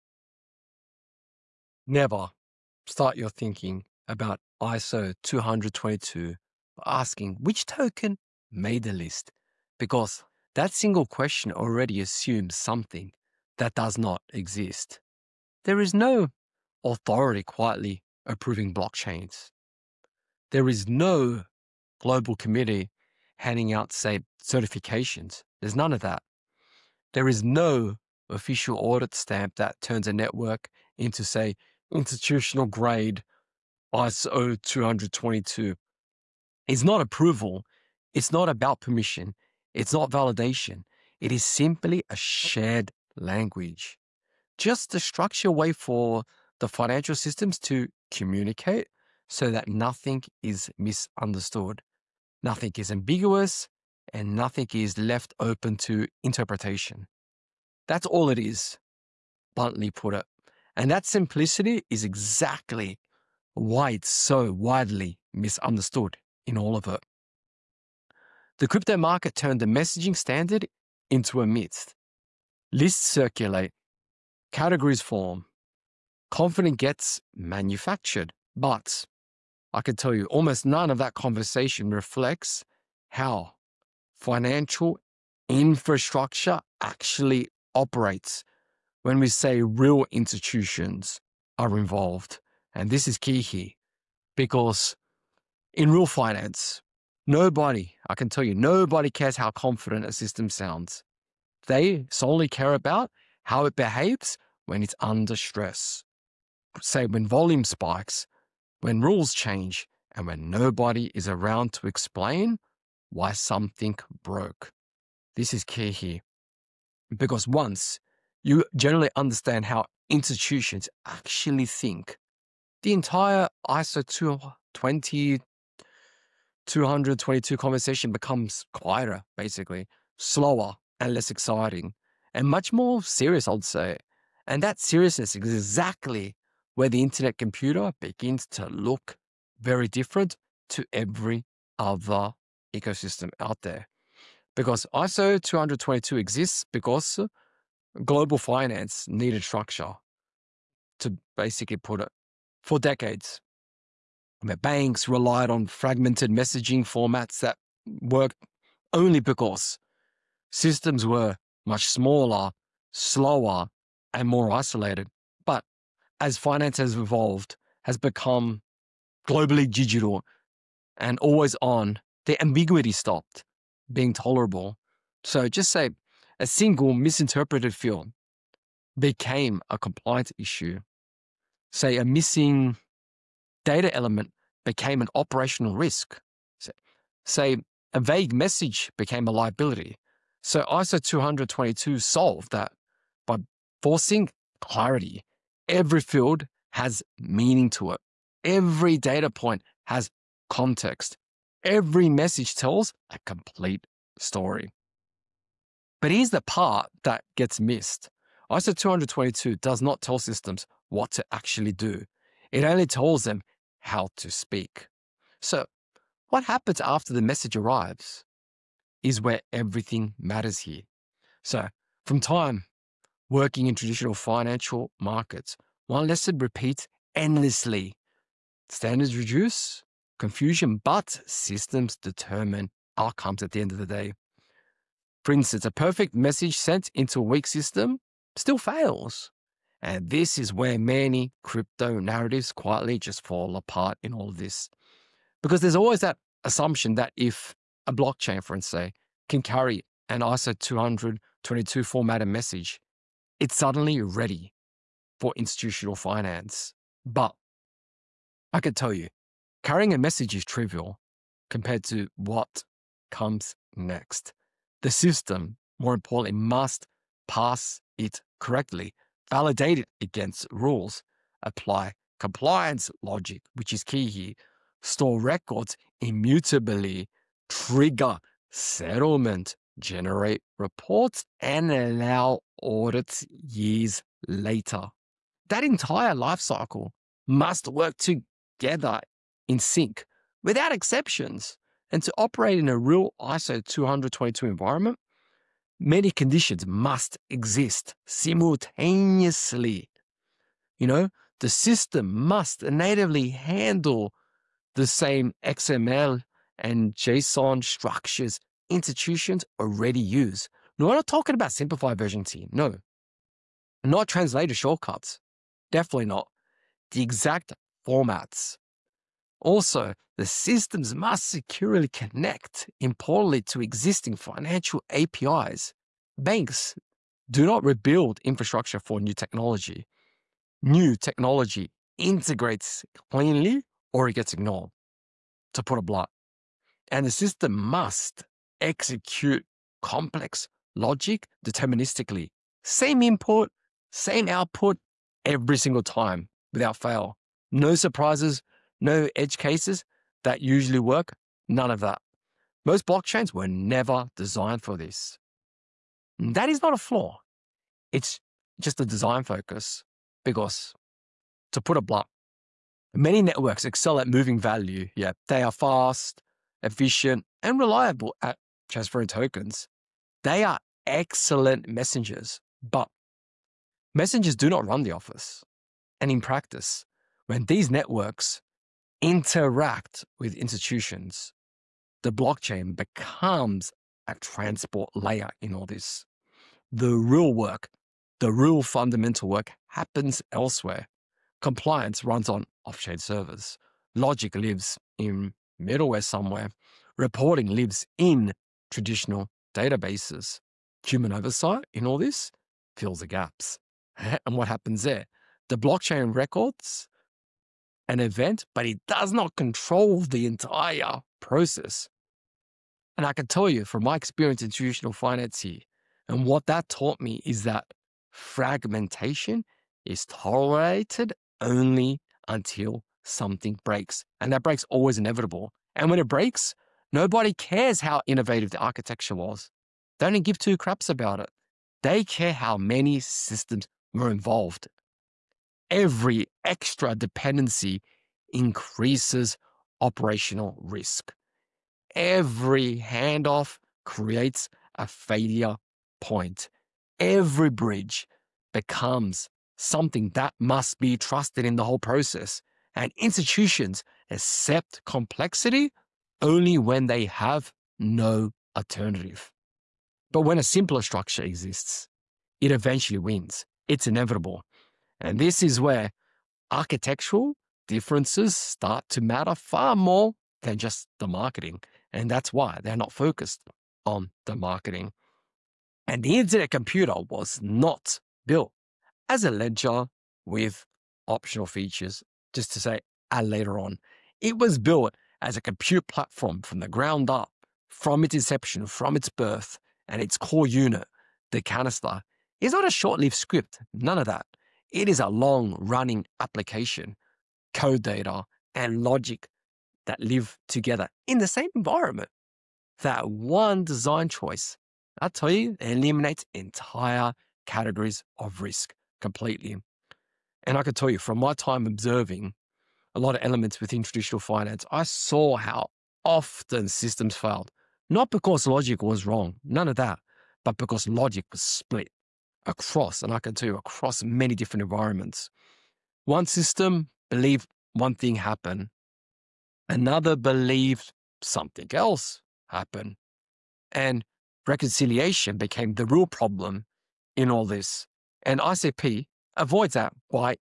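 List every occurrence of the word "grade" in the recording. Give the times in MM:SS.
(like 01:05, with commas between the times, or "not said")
00:32.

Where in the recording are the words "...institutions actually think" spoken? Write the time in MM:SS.
02:00.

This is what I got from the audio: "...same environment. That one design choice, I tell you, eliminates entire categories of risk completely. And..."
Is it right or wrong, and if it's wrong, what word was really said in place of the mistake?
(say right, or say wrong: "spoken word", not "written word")
right.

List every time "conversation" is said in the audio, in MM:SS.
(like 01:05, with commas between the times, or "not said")
01:21, 02:07.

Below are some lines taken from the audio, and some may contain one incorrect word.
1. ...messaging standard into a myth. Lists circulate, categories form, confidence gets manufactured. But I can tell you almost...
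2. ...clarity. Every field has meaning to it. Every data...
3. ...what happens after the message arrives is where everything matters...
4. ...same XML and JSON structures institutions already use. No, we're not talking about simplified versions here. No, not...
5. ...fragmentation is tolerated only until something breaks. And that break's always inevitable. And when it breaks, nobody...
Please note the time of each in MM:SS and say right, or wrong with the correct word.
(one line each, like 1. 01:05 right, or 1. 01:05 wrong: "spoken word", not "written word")
1. 01:09 right
2. 03:14 right
3. 03:36 right
4. 05:04 right
5. 06:58 right.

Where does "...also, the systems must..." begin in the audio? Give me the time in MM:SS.
05:19.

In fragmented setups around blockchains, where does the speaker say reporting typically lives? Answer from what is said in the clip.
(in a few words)
traditional databases.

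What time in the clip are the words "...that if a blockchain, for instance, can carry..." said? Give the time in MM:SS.
04:06.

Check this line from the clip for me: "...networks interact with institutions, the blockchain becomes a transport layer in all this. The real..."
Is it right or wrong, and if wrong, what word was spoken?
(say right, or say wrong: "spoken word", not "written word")
right.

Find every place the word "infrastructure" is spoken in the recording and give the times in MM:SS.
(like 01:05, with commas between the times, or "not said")
01:25, 05:28.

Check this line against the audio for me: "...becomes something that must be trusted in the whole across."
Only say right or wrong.
wrong.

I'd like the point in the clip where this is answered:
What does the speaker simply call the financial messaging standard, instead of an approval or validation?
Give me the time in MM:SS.
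00:42.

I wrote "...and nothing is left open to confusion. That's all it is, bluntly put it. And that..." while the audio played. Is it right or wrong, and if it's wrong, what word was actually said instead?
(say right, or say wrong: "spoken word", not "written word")
wrong: "interpretation", not "confusion".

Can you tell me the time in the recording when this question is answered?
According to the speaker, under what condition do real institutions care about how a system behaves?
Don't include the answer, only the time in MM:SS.
01:44.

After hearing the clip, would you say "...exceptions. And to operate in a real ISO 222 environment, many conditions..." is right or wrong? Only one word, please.
right.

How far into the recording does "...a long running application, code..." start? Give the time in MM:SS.
08:14.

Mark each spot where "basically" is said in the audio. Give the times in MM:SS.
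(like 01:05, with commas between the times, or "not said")
02:09, 02:31.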